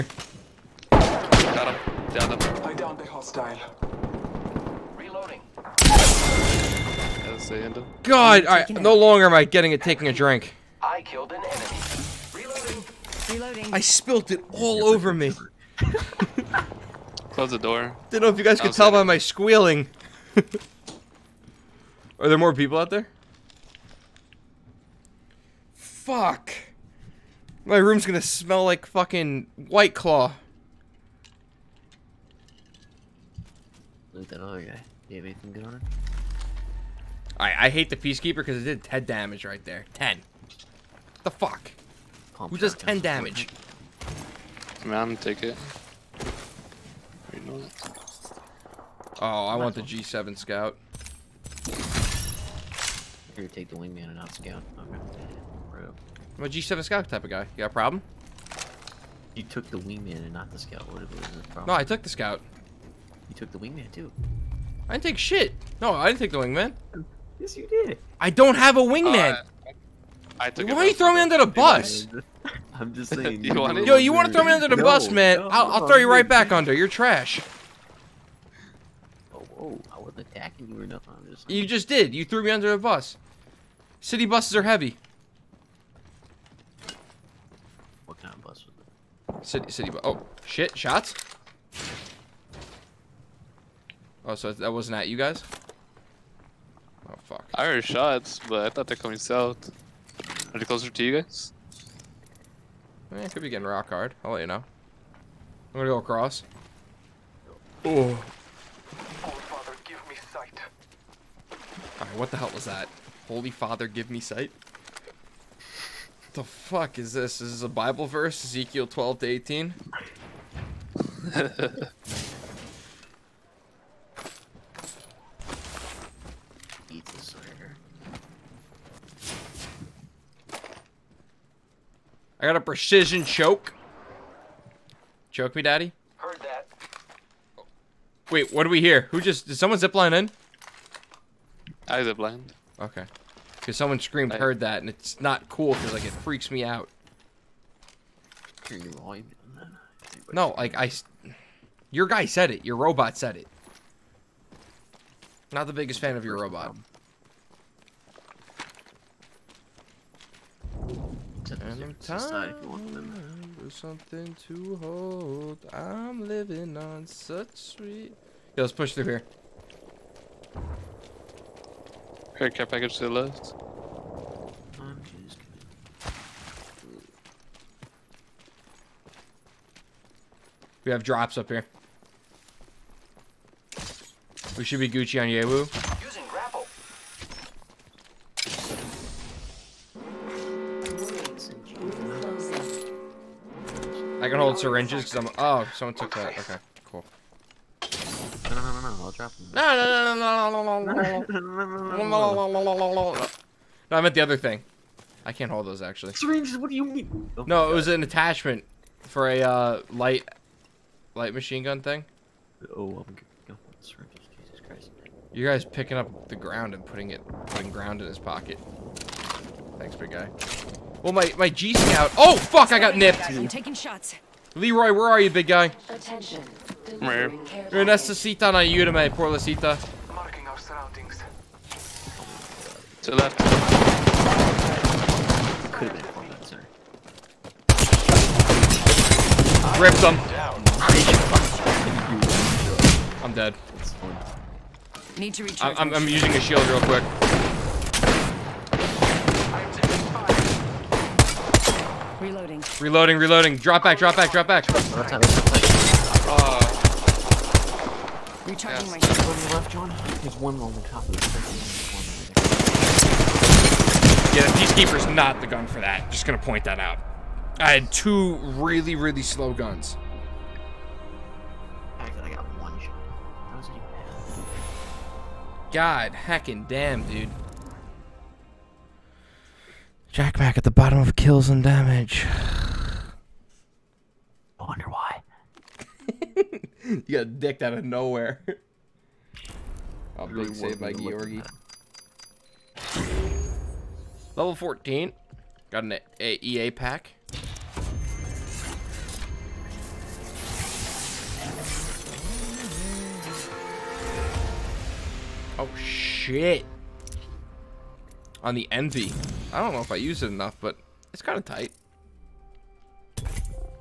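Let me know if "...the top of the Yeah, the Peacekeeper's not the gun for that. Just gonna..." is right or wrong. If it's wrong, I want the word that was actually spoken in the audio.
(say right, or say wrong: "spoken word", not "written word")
right.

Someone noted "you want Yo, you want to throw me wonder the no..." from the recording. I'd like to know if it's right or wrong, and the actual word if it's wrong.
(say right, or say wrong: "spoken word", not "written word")
wrong: "under", not "wonder".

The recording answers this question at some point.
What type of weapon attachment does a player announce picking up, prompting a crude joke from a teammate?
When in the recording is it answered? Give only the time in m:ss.
2:12.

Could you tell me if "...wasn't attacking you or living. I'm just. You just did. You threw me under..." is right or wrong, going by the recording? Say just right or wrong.
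wrong.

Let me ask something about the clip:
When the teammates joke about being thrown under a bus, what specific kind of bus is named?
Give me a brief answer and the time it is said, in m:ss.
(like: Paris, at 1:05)
City bus, at 1:29.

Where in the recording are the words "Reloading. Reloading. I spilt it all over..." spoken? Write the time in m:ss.
0:12.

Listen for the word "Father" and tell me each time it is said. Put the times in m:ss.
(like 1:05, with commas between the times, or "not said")
1:49, 1:53.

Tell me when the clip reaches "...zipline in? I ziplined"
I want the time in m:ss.
2:19.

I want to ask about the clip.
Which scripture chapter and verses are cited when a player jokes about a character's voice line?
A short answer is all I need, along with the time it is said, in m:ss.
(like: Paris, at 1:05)
Ezekiel 12 to 18, at 1:58.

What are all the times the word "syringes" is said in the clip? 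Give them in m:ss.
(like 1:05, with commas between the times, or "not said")
3:14, 3:26, 3:33.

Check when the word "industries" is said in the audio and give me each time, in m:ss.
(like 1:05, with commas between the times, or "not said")
not said.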